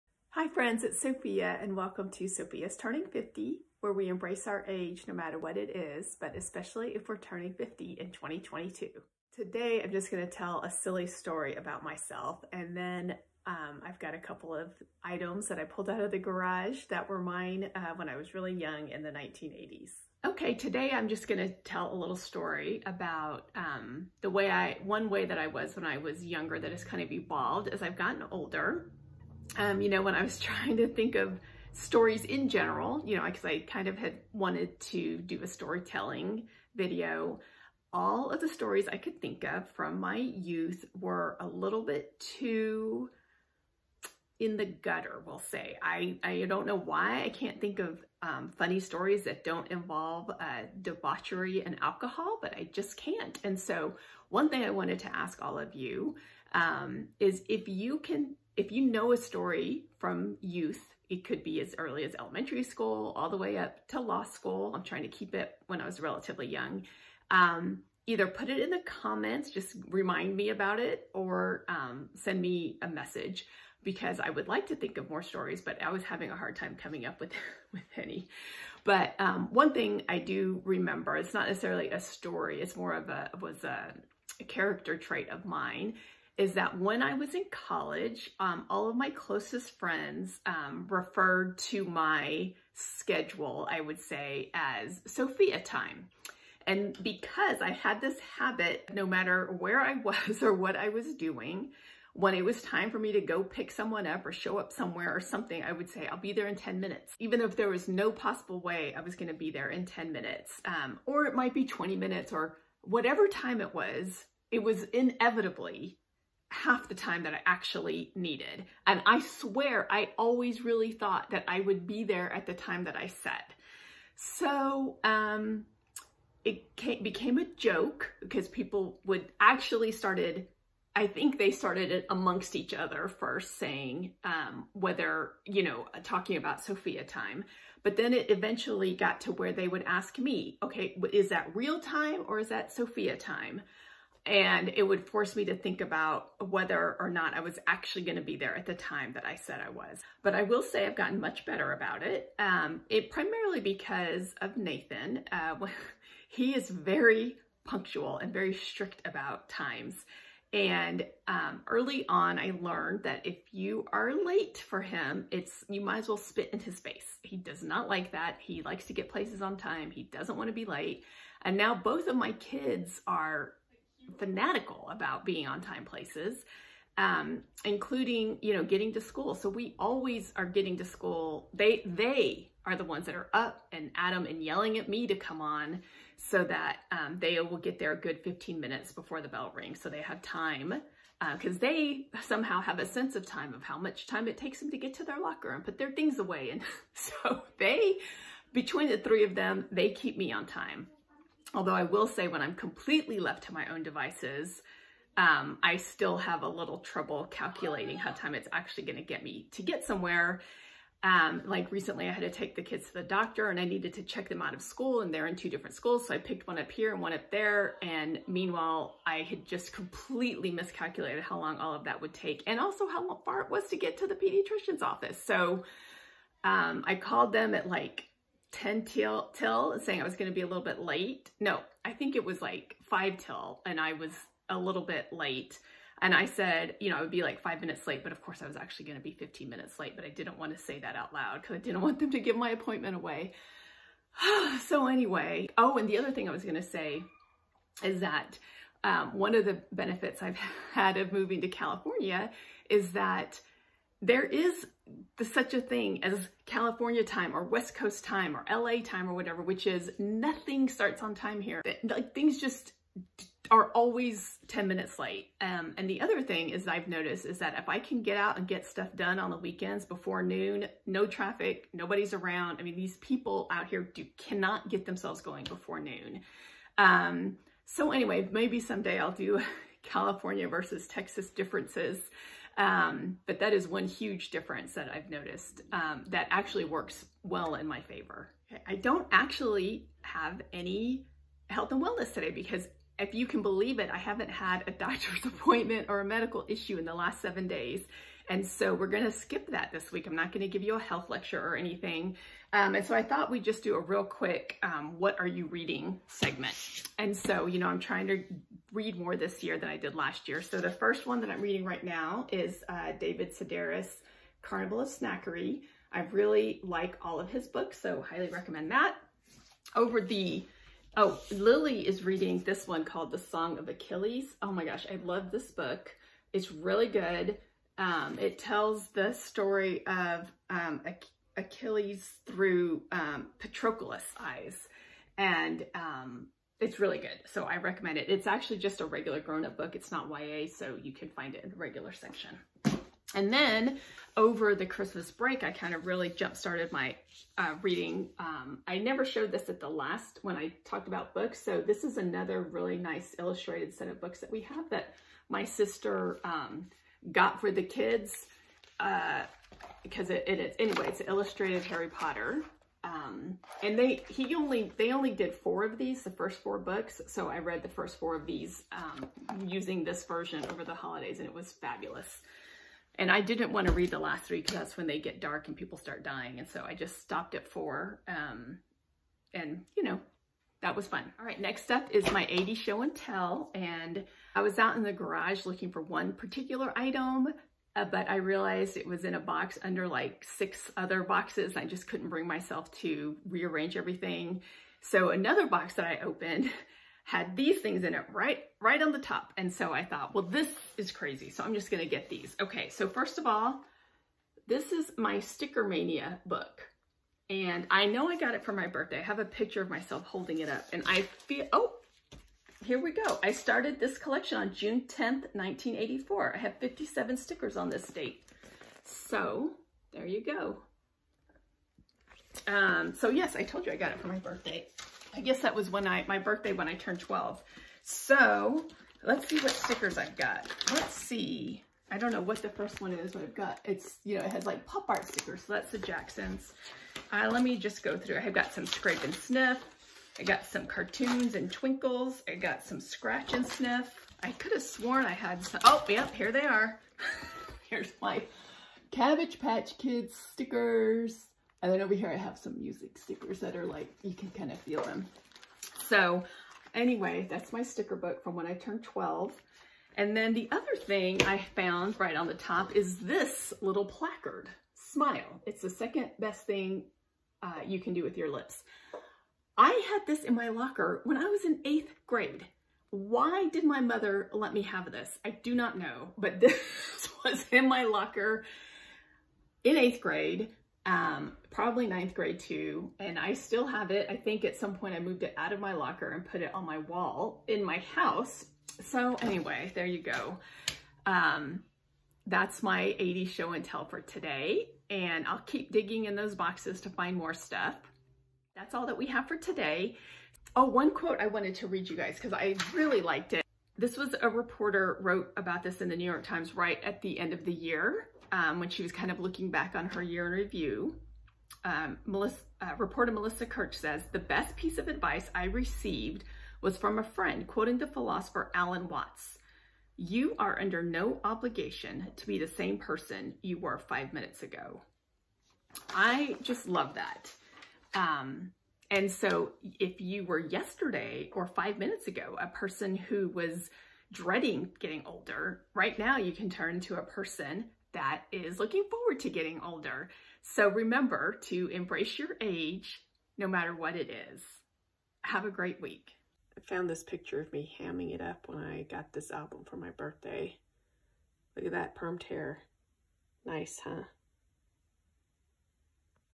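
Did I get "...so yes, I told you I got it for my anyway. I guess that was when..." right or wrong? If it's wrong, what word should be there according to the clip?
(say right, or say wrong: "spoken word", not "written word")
wrong: "birthday", not "anyway".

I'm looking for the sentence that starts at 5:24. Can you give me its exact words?
Oh my gosh, I love this book.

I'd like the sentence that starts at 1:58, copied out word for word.
And I swear, I always really thought that I would be there at the time that I said.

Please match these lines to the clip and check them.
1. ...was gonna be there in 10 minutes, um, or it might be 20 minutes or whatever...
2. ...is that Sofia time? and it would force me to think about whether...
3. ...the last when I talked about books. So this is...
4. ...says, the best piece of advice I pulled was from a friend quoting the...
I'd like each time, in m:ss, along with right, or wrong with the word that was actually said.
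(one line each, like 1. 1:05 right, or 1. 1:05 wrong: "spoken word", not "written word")
1. 1:49 right
2. 2:22 right
3. 5:49 right
4. 8:33 wrong: "received", not "pulled".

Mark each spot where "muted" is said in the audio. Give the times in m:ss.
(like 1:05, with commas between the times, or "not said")
not said.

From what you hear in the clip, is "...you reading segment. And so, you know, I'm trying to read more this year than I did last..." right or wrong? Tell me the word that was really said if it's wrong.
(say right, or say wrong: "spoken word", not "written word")
right.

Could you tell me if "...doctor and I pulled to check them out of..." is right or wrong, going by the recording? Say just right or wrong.
wrong.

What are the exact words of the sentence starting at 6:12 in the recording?
And I didn't want to read the last three because that's when they get dark and people start dying.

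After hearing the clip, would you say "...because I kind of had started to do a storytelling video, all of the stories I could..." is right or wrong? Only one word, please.
wrong.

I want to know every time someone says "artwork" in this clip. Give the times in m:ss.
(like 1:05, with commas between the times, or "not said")
not said.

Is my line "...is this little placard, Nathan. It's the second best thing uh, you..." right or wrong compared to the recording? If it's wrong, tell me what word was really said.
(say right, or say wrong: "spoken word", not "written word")
wrong: "Smile", not "Nathan".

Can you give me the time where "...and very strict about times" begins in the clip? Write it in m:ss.
2:38.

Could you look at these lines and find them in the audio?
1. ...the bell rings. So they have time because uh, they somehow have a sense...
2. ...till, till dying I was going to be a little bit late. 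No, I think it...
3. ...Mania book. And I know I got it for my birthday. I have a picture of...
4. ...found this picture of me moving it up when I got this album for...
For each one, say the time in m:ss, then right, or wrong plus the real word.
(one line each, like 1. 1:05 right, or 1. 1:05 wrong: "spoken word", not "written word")
1. 3:09 right
2. 3:48 wrong: "saying", not "dying"
3. 6:45 right
4. 9:06 wrong: "hamming", not "moving".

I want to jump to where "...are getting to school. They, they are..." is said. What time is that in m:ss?
3:00.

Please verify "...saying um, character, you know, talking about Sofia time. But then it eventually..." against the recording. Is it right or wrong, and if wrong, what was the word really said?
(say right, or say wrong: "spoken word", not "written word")
wrong: "whether", not "character".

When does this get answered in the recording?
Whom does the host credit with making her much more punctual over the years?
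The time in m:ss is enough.
2:34.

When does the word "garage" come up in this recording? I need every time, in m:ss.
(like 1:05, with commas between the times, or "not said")
0:16, 6:24.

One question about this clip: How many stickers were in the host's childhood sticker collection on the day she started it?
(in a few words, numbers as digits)
57.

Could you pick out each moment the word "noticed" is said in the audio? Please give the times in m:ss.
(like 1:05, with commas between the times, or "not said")
4:26, 4:45.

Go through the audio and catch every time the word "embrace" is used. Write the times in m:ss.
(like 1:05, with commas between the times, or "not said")
0:04, 9:01.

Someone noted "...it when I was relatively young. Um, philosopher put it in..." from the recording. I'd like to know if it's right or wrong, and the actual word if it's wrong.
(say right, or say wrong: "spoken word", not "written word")
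wrong: "either", not "philosopher".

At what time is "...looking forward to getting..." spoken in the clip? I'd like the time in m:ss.
8:58.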